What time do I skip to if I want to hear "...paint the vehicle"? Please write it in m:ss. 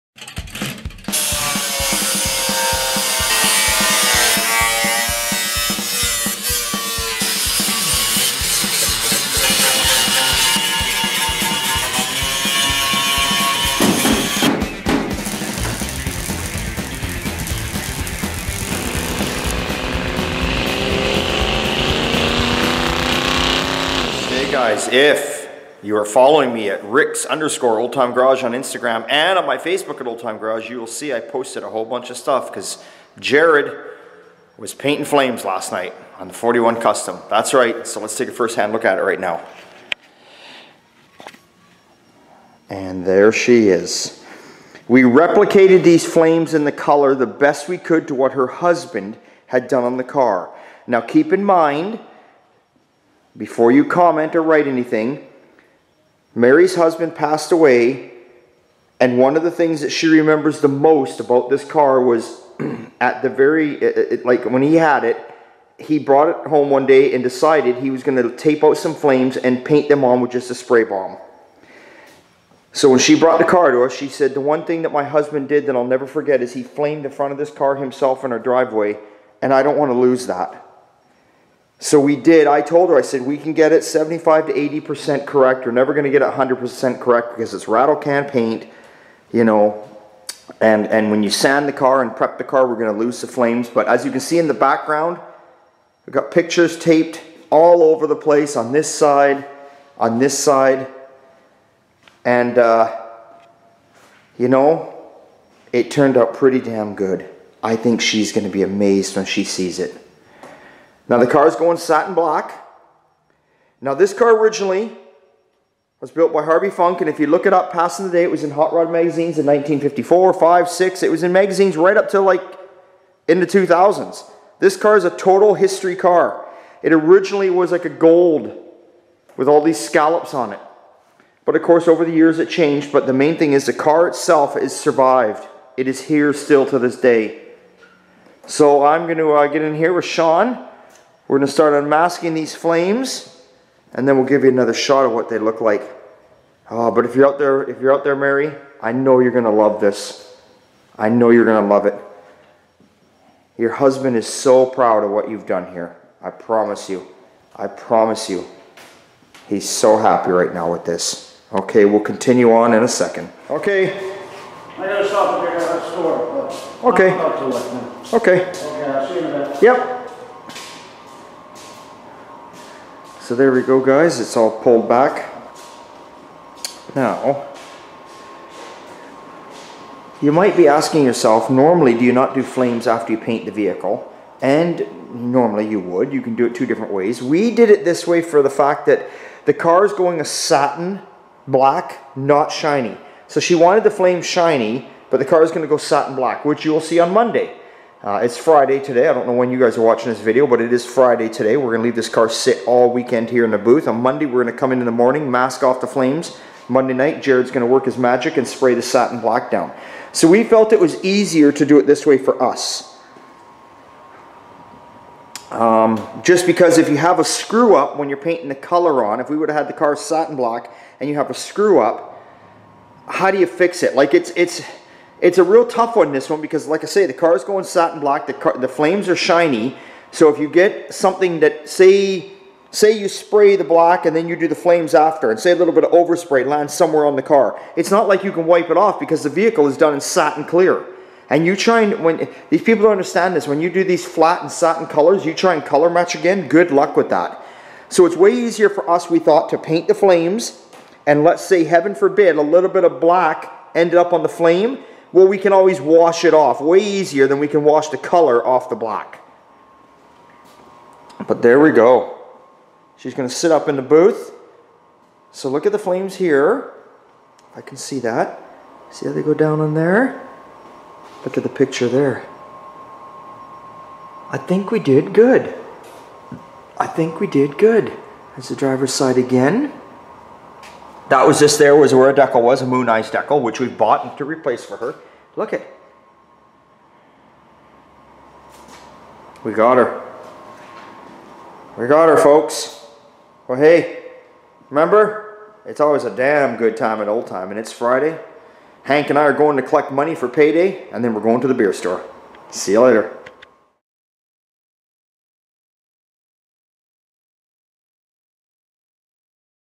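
3:03.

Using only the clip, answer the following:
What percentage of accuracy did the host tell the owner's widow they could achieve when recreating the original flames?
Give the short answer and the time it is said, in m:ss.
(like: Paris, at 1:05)
75 to 80%, at 1:23.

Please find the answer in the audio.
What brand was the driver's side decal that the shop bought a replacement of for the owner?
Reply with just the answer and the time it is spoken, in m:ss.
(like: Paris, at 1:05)
Mooneyes, at 4:42.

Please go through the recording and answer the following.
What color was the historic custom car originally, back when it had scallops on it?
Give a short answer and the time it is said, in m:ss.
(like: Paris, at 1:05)
Gold, at 2:07.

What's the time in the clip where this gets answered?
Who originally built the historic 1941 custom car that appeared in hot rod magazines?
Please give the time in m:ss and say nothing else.
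1:56.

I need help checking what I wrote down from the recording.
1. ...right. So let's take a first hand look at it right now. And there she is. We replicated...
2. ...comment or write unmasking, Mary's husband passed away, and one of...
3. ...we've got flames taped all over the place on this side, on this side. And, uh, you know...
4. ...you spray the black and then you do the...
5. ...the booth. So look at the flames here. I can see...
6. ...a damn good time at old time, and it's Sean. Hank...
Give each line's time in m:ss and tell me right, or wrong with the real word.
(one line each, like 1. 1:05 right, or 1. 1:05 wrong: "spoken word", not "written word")
1. 0:37 right
2. 0:53 wrong: "anything", not "unmasking"
3. 1:36 wrong: "pictures", not "flames"
4. 3:52 right
5. 4:23 right
6. 4:56 wrong: "Friday", not "Sean".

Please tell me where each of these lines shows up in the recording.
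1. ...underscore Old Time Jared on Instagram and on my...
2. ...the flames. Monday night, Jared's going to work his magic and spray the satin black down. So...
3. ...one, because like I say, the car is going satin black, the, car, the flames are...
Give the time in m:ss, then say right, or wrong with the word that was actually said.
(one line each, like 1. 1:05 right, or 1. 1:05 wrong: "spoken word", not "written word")
1. 0:27 wrong: "Garage", not "Jared"
2. 3:25 right
3. 3:46 right.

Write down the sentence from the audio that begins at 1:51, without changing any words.
Now the car is going satin black.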